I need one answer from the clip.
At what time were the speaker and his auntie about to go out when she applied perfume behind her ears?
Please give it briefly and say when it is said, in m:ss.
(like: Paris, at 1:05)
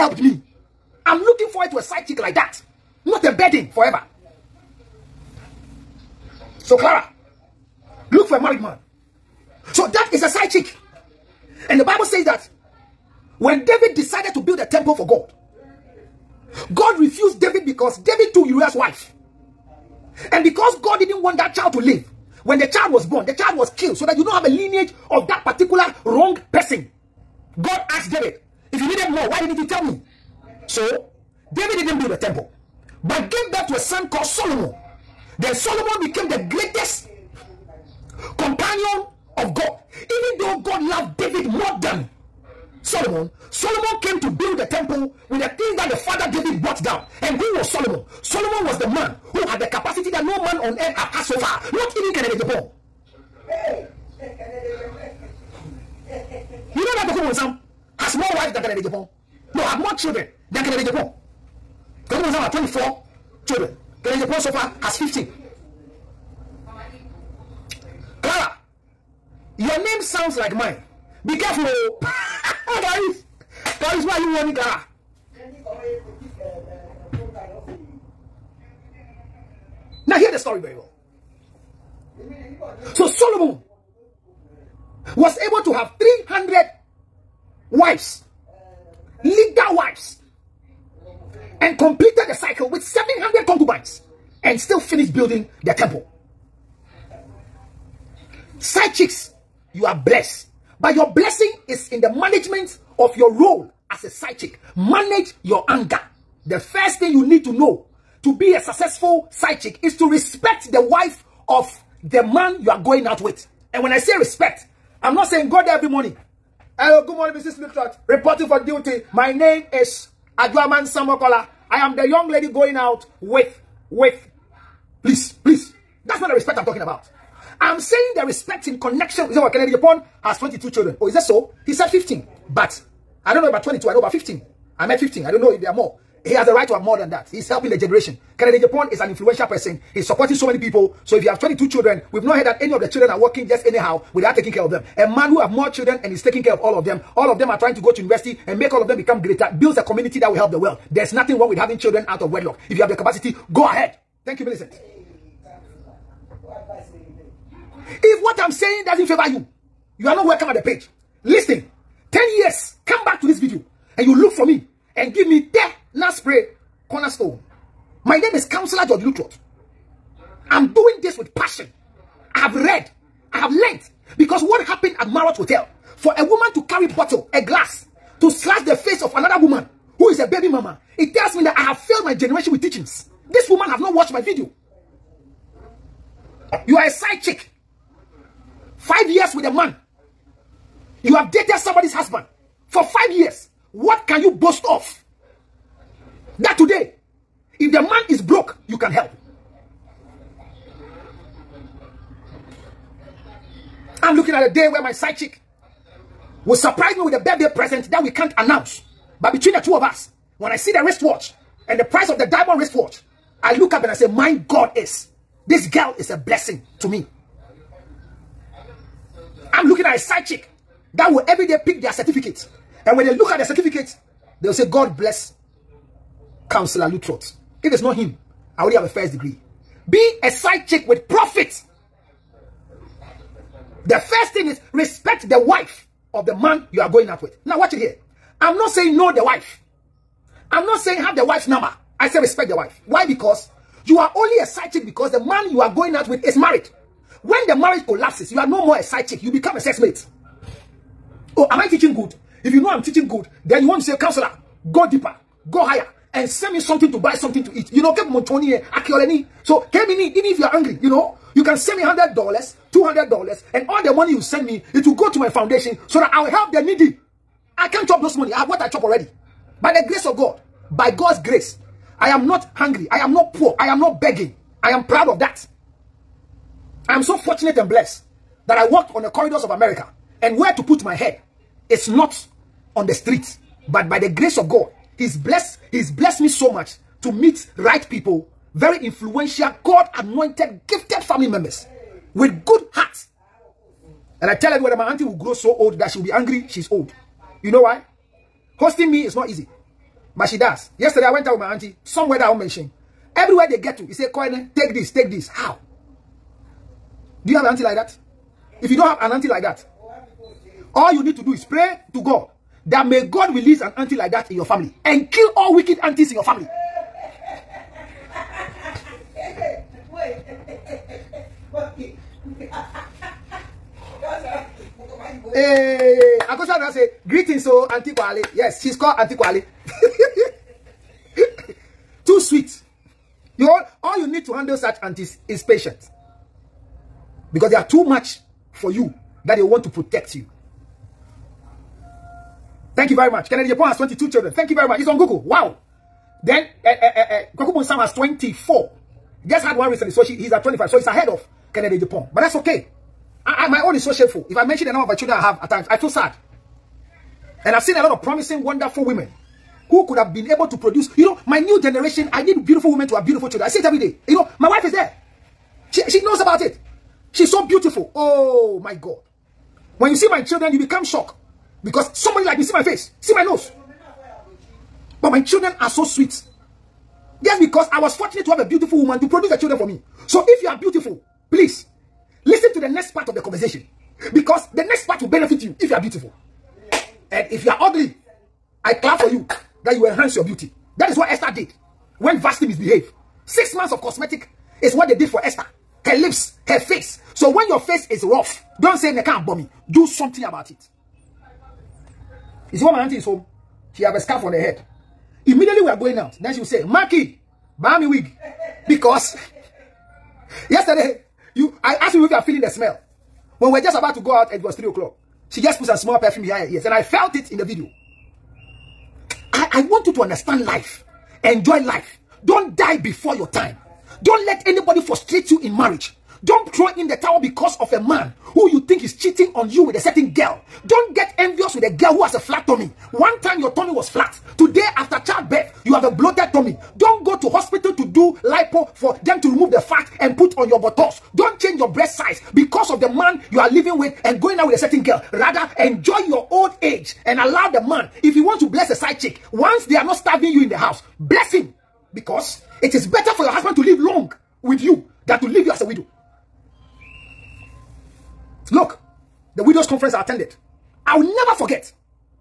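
3 o'clock, at 6:54.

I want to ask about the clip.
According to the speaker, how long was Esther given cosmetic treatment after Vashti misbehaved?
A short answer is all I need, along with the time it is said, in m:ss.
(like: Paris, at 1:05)
Six months, at 6:33.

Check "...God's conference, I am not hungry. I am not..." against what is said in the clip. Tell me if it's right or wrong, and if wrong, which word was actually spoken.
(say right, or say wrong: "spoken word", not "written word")
wrong: "grace", not "conference".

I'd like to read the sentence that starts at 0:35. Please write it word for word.
Then Solomon became the greatest companion of God.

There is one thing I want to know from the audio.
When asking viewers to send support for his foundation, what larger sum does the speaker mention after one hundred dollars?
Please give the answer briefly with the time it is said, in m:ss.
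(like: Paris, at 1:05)
$200, at 4:22.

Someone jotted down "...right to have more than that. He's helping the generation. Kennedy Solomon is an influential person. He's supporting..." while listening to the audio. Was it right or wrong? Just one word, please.
wrong.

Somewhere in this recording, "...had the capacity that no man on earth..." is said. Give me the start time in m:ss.
0:49.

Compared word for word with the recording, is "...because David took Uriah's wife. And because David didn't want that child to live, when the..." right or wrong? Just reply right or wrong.
wrong.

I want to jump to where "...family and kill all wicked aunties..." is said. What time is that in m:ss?
5:14.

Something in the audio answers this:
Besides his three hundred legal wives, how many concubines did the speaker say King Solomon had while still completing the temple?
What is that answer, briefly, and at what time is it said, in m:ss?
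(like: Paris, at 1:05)
700, at 1:32.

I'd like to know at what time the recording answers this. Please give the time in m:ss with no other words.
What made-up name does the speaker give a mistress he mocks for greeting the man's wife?
2:00.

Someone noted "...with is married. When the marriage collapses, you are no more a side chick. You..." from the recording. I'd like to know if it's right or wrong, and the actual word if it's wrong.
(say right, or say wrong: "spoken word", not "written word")
right.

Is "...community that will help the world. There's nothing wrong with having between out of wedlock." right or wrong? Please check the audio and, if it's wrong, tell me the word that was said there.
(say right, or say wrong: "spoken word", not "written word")
wrong: "children", not "between".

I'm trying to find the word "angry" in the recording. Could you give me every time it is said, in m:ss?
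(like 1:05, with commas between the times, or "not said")
4:20, 4:56.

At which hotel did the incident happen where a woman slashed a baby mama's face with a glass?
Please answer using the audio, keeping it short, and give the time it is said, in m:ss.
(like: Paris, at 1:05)
Marriott Hotel, at 2:55.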